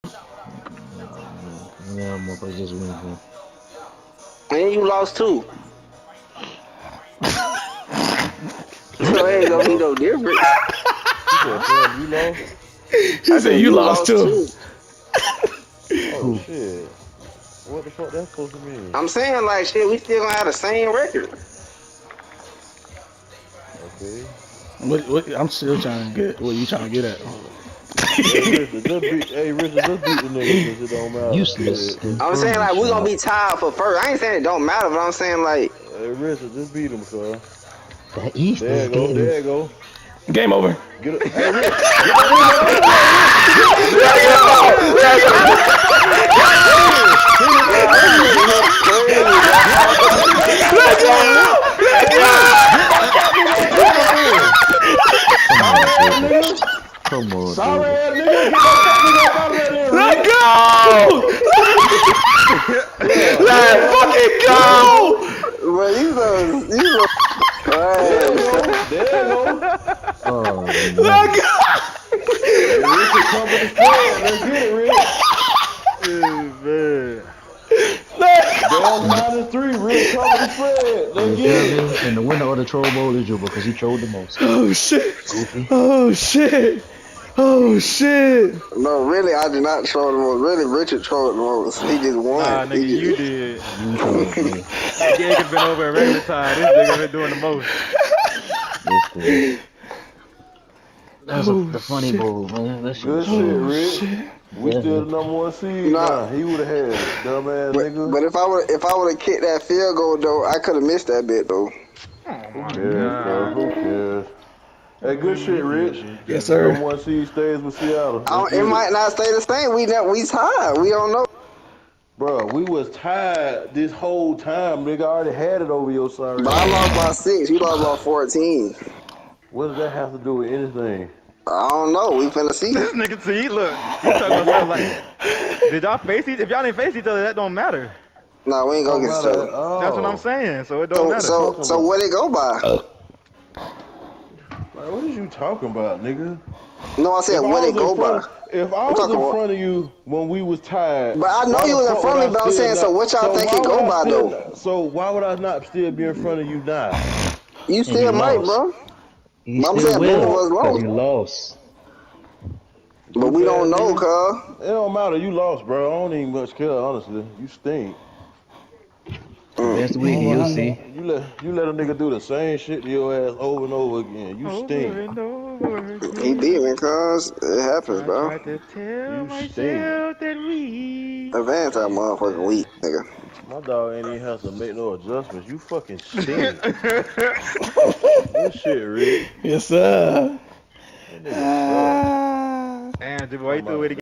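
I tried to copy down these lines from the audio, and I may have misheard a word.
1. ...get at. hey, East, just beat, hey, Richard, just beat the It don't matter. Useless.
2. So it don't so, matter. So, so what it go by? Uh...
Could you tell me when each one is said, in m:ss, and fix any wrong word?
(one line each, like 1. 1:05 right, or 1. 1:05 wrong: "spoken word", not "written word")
1. 0:26 wrong: "Richard", not "East"
2. 2:20 right.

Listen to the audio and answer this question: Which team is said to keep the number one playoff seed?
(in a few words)
Seattle.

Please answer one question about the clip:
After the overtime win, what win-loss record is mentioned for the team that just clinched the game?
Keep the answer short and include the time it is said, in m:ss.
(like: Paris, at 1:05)
9 and 3, at 1:19.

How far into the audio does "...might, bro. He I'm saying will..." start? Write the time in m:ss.
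2:38.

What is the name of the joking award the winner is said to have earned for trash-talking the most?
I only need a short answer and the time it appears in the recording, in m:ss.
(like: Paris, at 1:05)
troll bowl, at 1:22.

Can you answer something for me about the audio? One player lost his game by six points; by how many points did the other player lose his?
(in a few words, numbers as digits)
14.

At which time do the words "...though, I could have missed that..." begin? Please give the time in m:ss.
1:50.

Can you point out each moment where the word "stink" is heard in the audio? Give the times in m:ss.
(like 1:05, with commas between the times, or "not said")
2:47, 2:54, 2:59.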